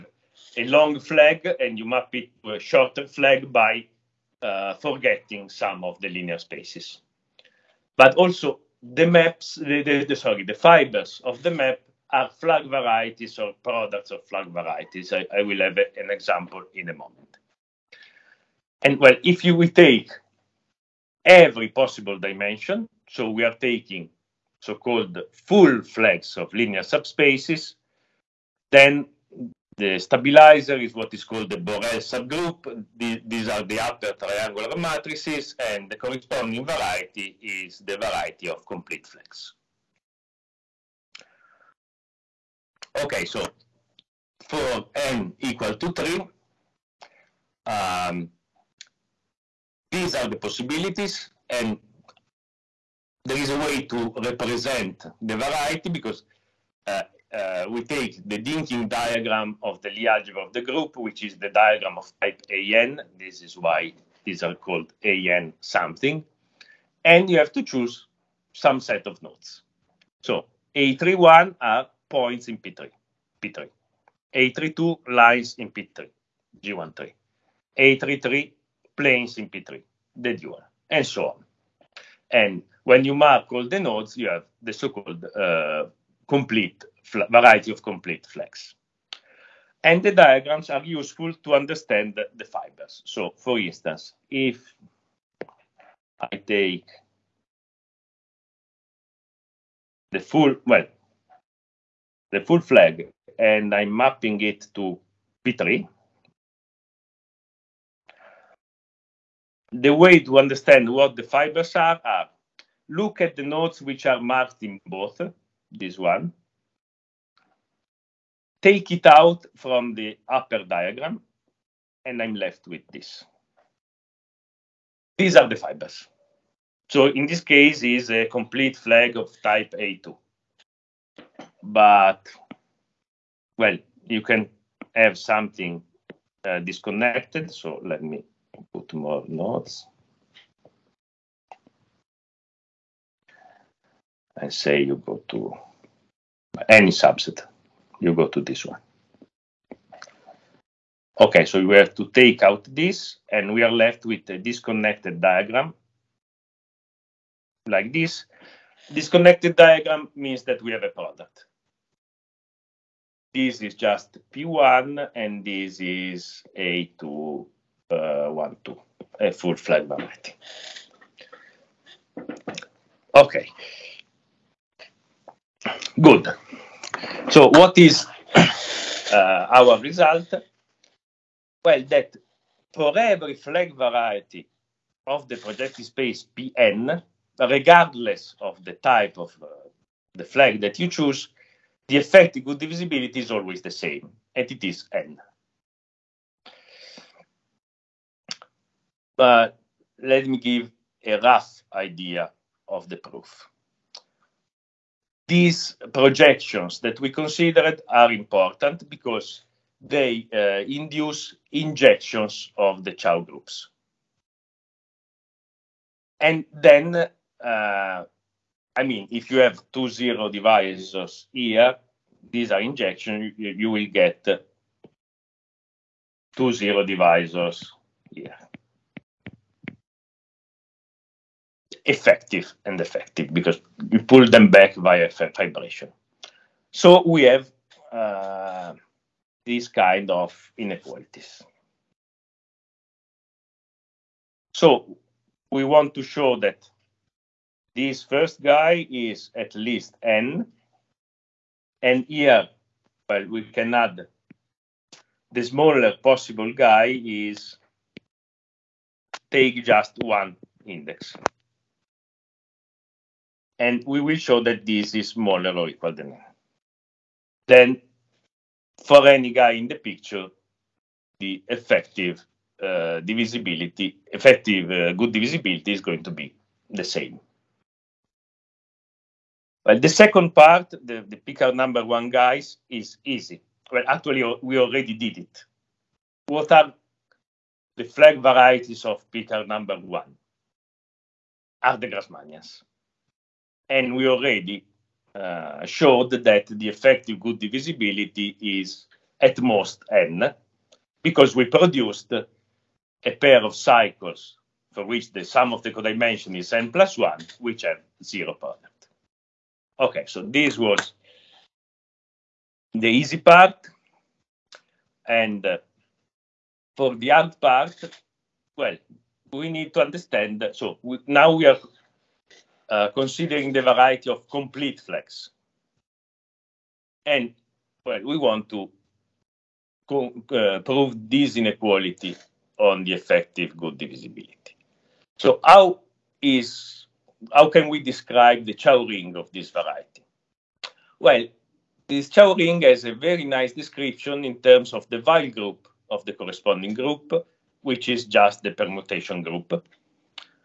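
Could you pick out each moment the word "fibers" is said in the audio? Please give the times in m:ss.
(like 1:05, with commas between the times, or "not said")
0:10, 1:32, 1:51, 2:05.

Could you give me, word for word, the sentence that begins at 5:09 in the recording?
Okay, so this was the easy part.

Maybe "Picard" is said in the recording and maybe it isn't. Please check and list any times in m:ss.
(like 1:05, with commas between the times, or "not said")
4:41, 4:49.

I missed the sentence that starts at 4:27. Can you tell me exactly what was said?
Then for any guy in the picture, the effective uh, divisibility, effective uh, good divisibility is going to be the same.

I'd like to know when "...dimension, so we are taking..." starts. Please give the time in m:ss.
0:22.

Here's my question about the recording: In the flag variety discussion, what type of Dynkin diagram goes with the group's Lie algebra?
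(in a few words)
type AN.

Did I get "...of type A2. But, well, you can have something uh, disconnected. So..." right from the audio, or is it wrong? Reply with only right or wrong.
right.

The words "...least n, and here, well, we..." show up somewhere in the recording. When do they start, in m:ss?
4:09.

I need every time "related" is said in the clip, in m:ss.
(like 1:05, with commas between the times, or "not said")
not said.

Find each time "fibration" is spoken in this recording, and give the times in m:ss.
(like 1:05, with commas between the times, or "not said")
3:55.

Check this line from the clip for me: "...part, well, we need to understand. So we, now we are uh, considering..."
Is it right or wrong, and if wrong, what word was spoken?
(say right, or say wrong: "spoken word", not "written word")
right.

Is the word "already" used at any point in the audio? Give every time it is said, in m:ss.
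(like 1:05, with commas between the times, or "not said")
4:44, 4:54.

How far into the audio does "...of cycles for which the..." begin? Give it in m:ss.
5:03.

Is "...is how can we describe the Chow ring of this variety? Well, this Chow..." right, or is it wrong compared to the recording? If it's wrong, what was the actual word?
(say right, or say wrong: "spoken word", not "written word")
right.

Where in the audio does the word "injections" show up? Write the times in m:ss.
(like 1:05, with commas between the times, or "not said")
3:31, 3:42.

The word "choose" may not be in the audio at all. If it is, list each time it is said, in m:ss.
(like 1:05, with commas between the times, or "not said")
1:07, 3:10.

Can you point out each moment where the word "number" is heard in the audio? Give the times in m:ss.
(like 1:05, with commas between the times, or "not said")
4:41, 4:49.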